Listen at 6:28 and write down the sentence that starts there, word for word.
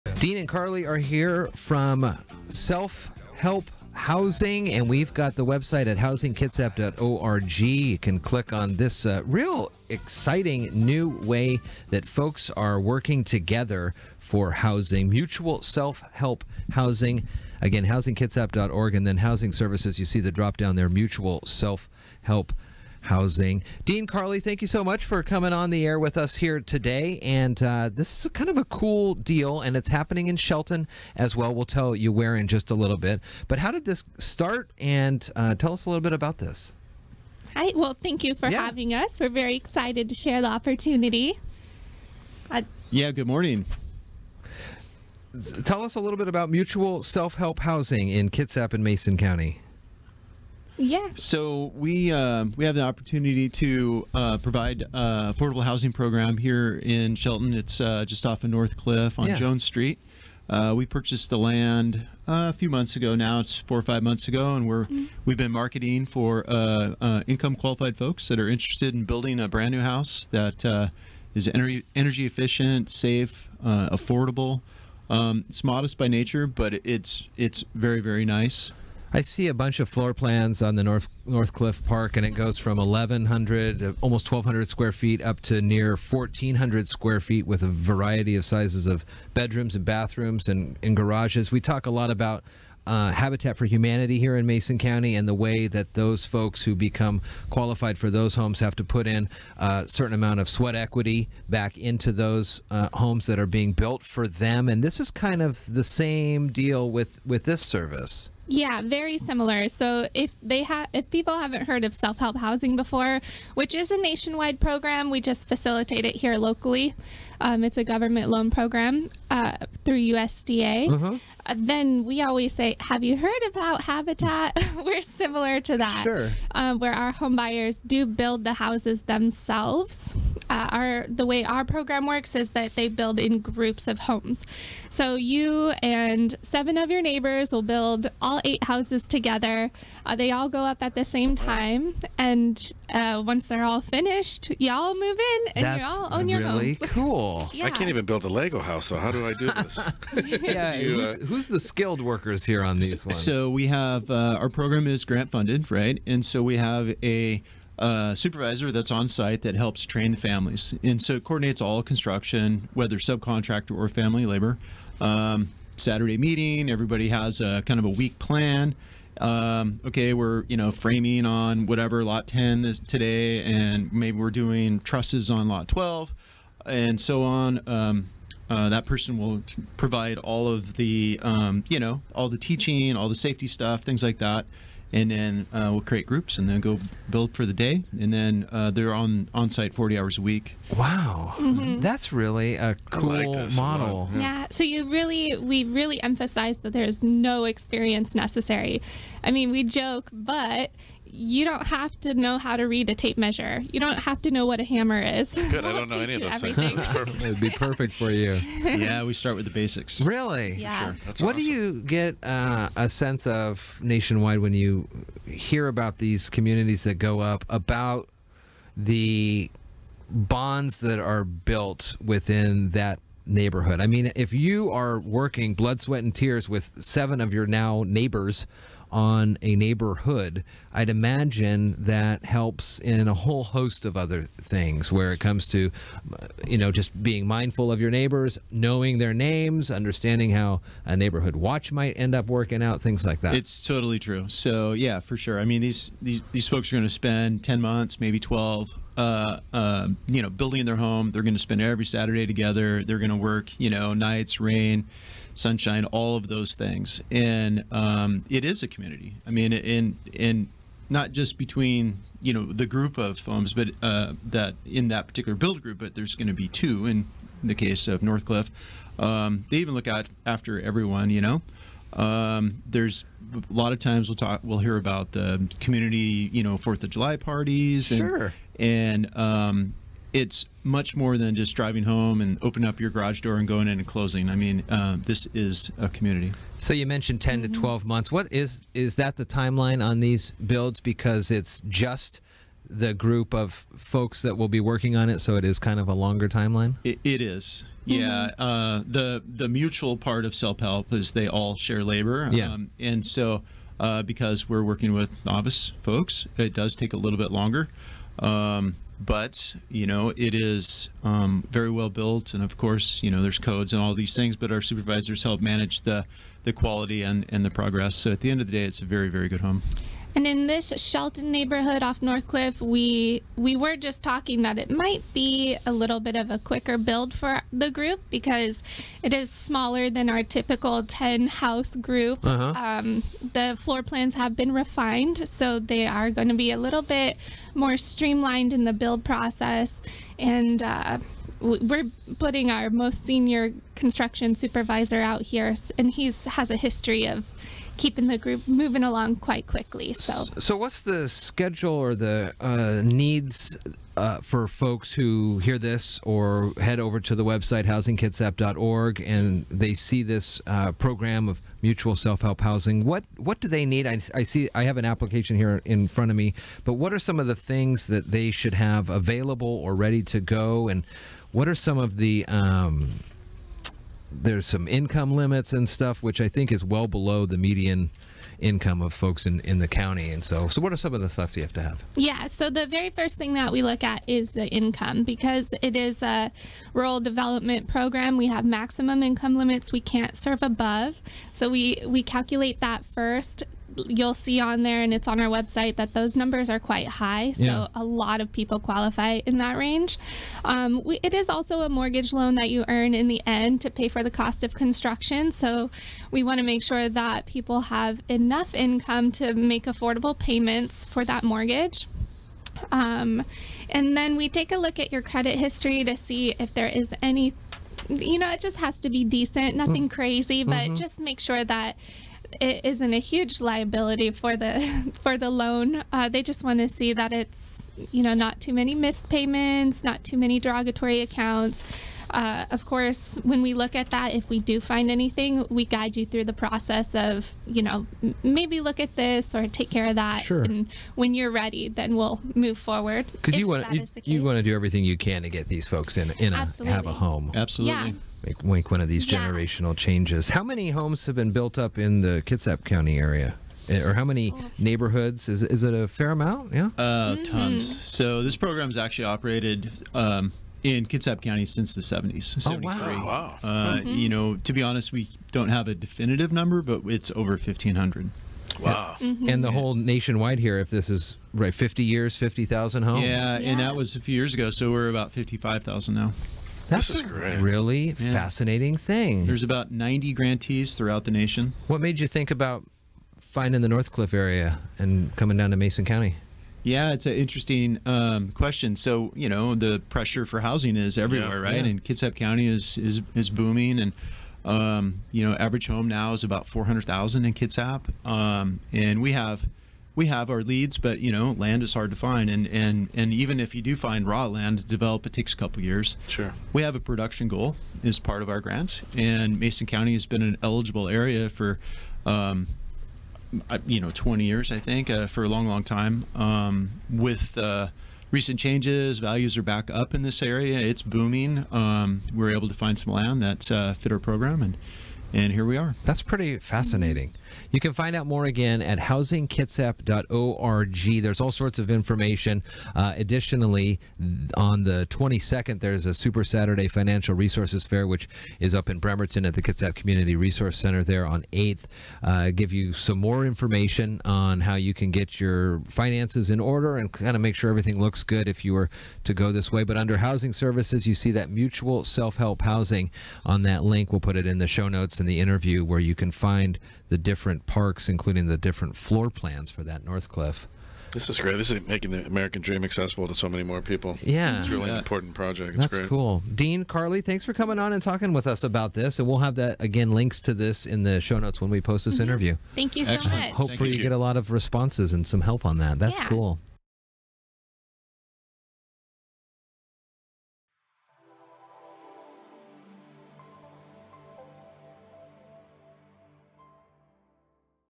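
We have maximum income limits we can't serve above.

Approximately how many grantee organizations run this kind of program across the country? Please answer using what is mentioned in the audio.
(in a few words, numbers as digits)
About 90.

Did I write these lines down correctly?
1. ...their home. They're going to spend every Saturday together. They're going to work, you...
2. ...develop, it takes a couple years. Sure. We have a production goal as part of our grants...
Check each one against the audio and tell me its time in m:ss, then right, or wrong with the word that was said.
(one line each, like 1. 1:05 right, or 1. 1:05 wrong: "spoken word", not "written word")
1. 4:10 right
2. 8:24 right.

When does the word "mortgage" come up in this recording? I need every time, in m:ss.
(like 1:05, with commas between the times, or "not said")
6:41, 6:51.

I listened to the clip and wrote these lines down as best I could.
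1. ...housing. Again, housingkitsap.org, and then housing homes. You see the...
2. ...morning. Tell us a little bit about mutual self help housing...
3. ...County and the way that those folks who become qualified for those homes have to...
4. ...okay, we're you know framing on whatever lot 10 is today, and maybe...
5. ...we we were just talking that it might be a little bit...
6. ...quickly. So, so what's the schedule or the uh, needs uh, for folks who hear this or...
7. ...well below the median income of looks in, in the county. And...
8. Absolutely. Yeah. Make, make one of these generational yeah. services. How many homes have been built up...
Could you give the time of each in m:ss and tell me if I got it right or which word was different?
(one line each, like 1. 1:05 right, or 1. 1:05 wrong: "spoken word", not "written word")
1. 0:16 wrong: "services", not "homes"
2. 0:43 right
3. 1:34 right
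4. 2:49 right
5. 5:22 right
6. 5:49 right
7. 6:16 wrong: "folks", not "looks"
8. 7:27 wrong: "changes", not "services".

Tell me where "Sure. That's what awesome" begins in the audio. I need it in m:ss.
3:30.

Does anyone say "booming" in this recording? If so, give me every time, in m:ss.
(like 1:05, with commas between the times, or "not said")
8:13, 8:40.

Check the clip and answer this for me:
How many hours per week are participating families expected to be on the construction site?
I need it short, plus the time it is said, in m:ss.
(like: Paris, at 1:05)
40, at 3:09.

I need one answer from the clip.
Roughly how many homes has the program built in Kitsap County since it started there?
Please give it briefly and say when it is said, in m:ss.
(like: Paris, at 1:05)
Over 1,500, at 7:47.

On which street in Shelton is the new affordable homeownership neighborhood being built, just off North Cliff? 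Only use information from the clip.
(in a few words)
Jones Street.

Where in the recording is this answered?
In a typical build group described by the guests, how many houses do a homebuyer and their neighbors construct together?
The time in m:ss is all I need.
2:18.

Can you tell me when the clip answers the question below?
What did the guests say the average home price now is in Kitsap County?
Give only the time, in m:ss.
8:16.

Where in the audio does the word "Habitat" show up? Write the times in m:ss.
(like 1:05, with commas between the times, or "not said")
1:33, 2:03.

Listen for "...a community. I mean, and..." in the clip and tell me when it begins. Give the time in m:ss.
4:18.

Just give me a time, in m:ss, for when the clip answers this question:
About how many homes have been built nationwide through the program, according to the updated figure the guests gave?
7:55.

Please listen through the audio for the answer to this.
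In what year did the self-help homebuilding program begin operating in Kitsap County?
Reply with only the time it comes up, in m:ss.
7:42.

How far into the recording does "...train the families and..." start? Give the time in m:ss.
2:39.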